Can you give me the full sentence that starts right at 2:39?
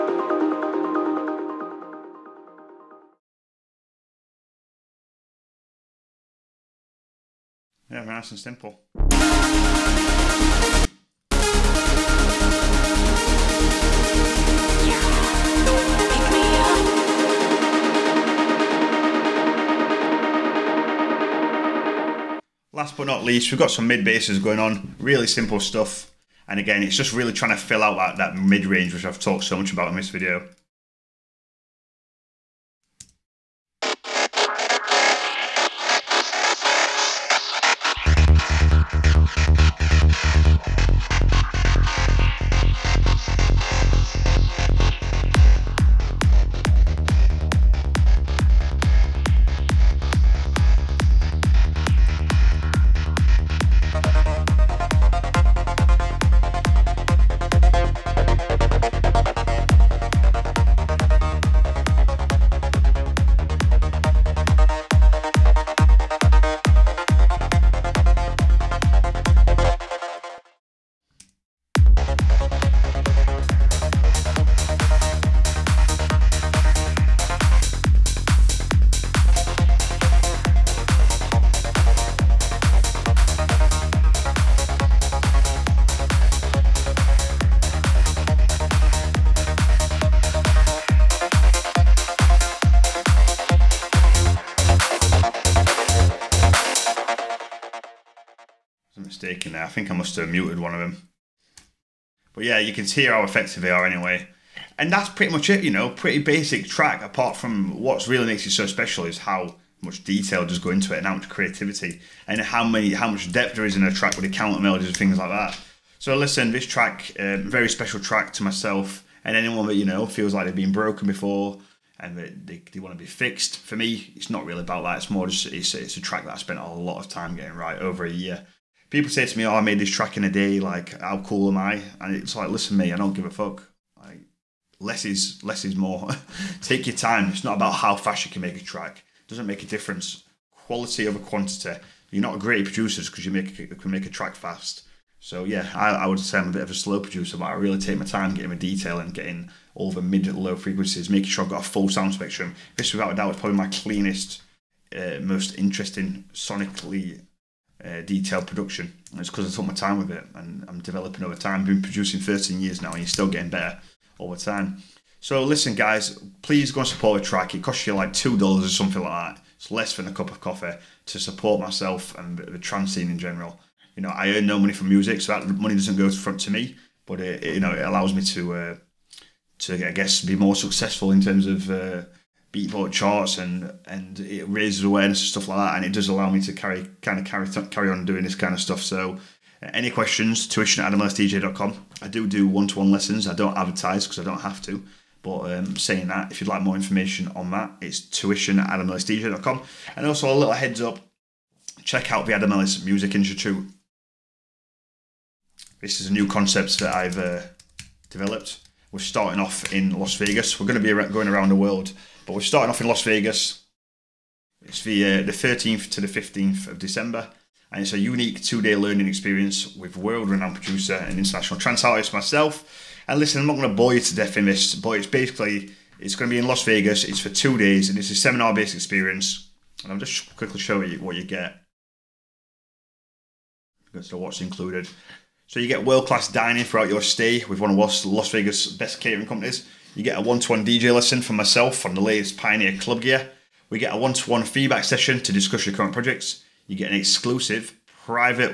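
And it's because I took my time with it and I'm developing over time.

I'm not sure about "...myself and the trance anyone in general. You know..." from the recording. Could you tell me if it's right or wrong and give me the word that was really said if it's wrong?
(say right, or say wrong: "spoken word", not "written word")
wrong: "scene", not "anyone".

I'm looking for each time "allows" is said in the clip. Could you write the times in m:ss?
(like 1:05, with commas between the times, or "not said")
2:57, 3:06.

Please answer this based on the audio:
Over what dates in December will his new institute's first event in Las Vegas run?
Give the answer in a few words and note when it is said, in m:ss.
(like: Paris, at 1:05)
13th to 15th December, at 3:35.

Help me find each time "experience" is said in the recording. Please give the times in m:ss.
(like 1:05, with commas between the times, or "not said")
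3:39, 3:48.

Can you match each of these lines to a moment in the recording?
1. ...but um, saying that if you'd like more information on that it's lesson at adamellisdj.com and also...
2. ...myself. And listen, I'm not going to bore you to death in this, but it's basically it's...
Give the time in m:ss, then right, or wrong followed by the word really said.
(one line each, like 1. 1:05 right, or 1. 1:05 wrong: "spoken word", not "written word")
1. 3:15 wrong: "tuition", not "lesson"
2. 3:42 right.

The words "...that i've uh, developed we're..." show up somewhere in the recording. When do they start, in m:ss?
3:26.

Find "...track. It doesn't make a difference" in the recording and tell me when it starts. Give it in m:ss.
2:18.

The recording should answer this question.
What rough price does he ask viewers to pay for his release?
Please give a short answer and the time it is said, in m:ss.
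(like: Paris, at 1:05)
$2, at 2:48.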